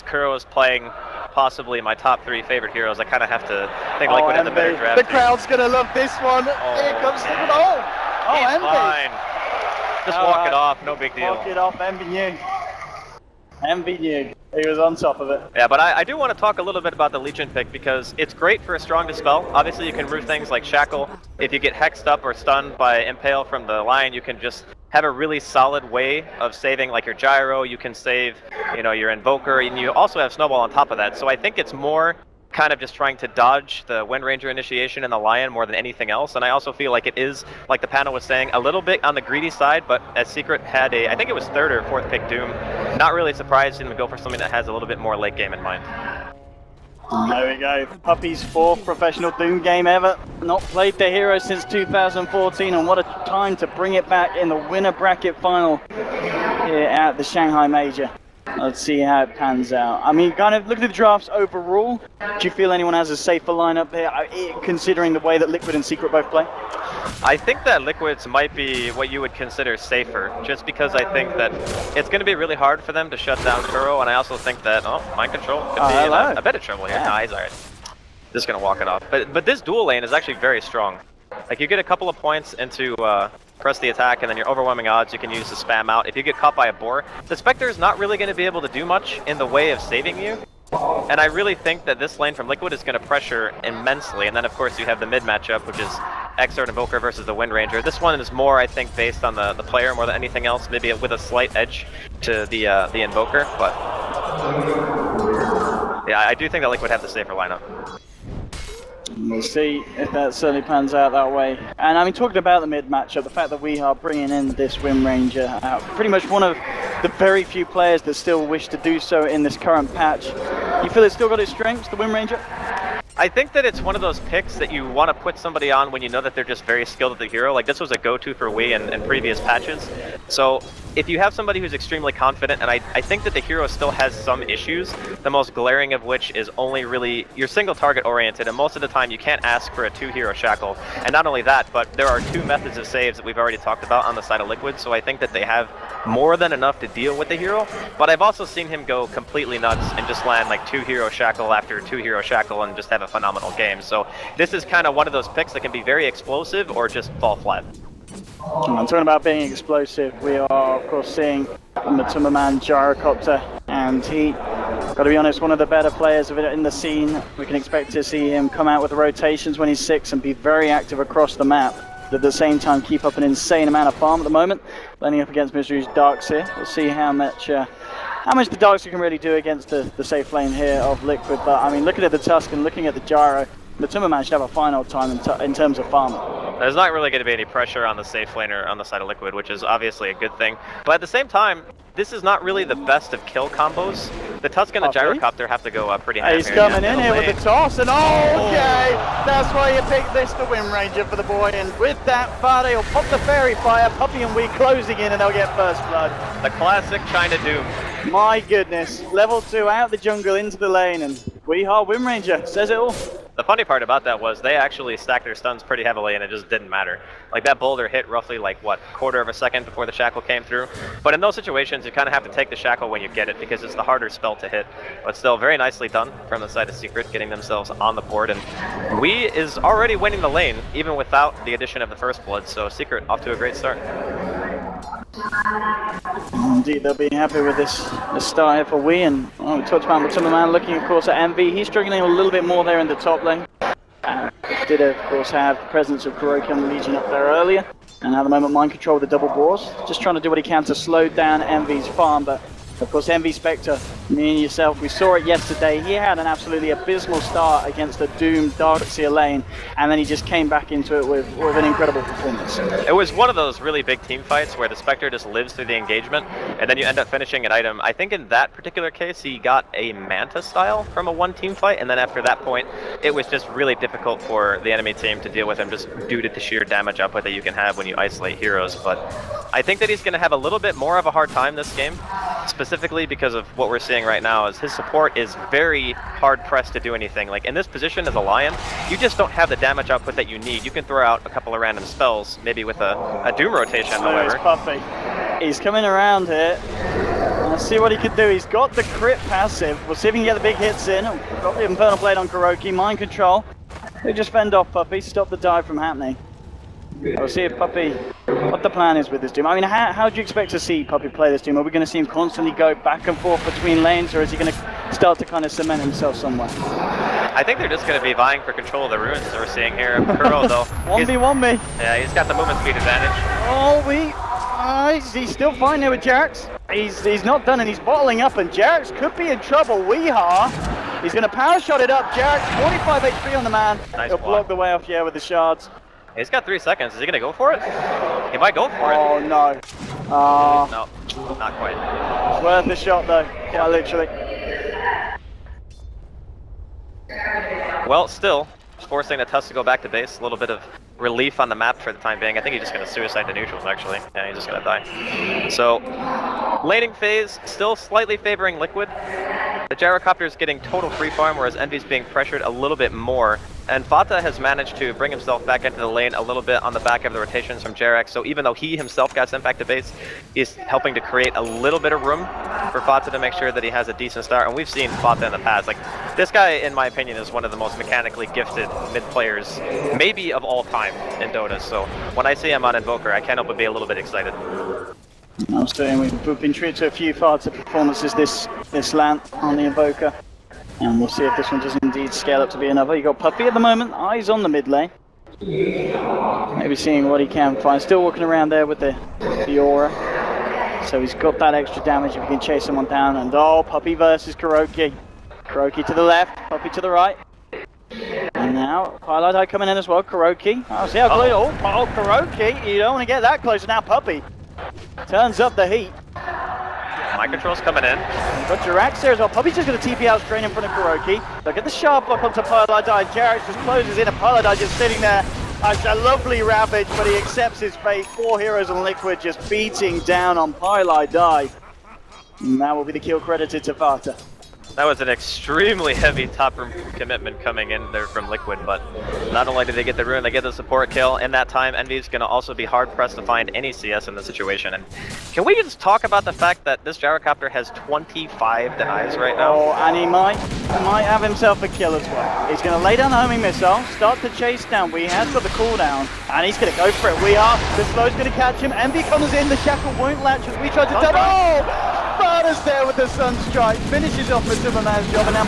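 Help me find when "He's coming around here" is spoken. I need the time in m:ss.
4:55.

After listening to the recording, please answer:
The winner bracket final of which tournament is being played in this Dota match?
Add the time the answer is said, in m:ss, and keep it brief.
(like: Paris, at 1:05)
Shanghai Major, at 0:57.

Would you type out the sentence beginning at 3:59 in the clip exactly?
And oh, we talked about Timmerman looking, of course, at Envy.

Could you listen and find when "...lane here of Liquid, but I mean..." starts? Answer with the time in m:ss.
3:00.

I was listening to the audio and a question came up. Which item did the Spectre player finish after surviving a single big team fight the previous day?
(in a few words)
Manta Style.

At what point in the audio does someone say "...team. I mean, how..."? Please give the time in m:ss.
5:09.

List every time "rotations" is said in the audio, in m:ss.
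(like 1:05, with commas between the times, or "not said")
2:48, 4:53, 6:07.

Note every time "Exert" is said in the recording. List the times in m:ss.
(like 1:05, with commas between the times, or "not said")
1:36.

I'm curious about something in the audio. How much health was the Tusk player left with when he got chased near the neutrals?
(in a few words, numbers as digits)
45 HP.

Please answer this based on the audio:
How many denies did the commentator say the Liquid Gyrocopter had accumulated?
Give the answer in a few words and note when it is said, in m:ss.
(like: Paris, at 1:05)
25, at 7:27.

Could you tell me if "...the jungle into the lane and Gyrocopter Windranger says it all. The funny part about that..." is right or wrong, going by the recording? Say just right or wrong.
wrong.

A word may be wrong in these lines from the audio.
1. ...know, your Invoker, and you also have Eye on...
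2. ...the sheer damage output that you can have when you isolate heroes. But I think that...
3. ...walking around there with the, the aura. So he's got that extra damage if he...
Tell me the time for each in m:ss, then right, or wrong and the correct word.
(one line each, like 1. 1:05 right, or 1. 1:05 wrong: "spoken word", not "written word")
1. 0:28 wrong: "Snowball", not "Eye"
2. 4:36 right
3. 6:38 right.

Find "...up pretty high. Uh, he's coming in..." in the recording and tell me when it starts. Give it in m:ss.
3:15.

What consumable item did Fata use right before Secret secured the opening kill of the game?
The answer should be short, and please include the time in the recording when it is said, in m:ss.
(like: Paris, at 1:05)
Faerie Fire, at 3:23.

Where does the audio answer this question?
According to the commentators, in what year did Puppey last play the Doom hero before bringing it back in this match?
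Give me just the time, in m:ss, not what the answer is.
0:51.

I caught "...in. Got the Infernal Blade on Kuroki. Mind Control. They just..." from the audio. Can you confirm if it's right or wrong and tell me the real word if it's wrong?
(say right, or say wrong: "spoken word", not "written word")
right.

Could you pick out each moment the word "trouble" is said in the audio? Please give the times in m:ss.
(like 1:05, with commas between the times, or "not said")
1:16, 5:29.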